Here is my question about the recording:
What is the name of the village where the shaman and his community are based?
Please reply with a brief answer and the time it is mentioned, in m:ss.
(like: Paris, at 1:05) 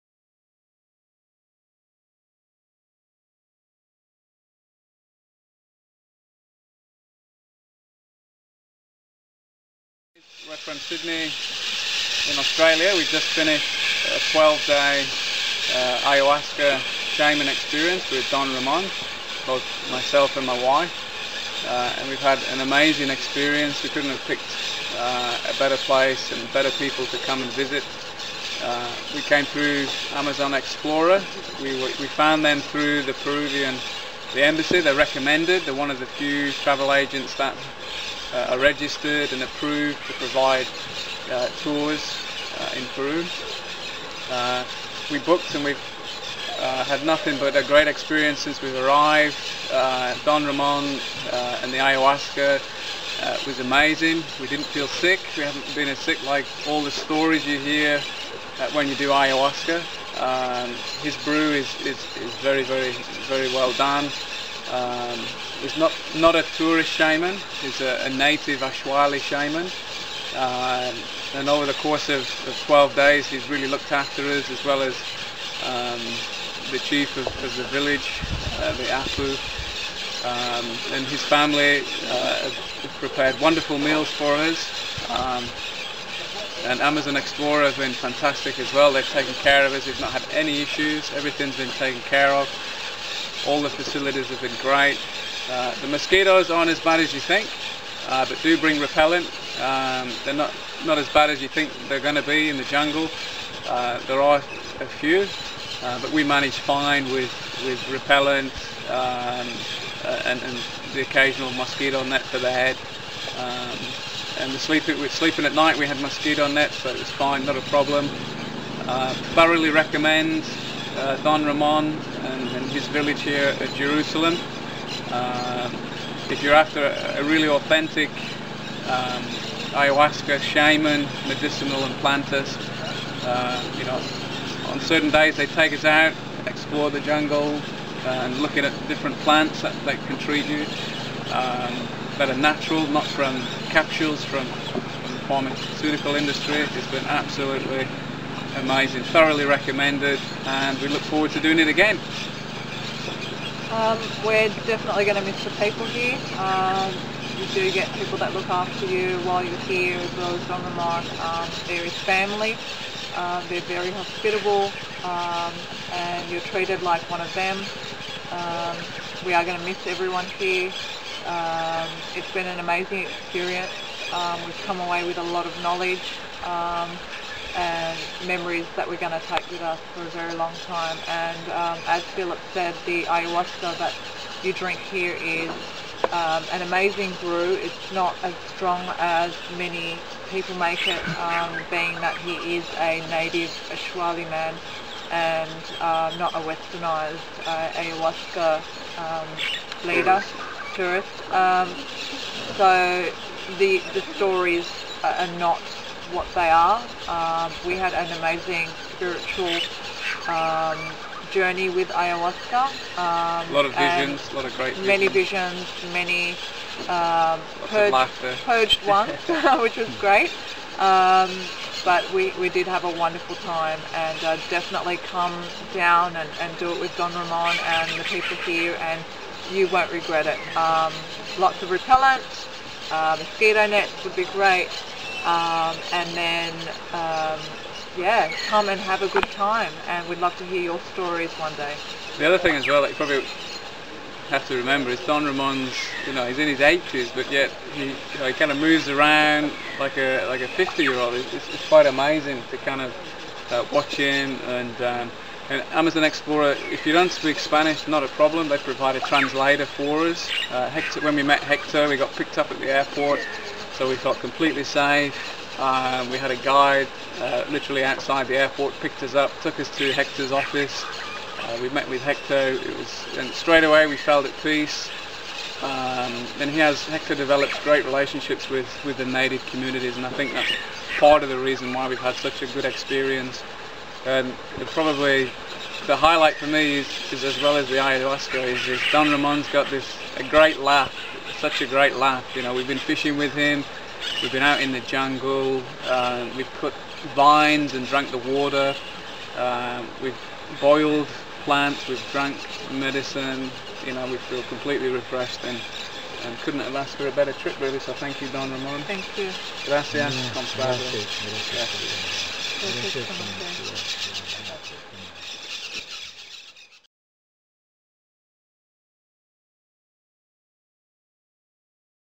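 Jerusalem, at 2:03.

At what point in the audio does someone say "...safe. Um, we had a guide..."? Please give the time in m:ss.
4:24.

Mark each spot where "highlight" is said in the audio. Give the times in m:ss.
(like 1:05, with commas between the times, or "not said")
4:45.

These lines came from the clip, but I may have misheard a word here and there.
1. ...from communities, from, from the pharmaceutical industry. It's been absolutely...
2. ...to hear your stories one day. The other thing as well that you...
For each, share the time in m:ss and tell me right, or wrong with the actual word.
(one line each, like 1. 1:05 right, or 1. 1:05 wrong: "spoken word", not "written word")
1. 2:23 wrong: "capsules", not "communities"
2. 4:00 right.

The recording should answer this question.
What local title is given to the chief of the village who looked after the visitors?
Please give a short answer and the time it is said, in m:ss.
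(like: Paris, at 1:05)
Apu, at 1:18.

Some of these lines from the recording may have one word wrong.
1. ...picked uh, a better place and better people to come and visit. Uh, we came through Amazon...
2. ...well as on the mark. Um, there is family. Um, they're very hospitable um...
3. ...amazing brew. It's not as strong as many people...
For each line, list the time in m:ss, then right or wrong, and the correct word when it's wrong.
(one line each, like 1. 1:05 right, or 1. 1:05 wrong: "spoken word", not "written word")
1. 0:24 right
2. 2:40 right
3. 3:06 right.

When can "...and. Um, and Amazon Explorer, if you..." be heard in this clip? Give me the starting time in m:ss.
4:14.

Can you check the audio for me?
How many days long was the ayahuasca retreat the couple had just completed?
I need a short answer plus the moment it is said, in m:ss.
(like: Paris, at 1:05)
12, at 0:14.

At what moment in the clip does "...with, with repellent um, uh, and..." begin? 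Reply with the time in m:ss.
1:47.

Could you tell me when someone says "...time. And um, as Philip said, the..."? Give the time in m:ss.
3:00.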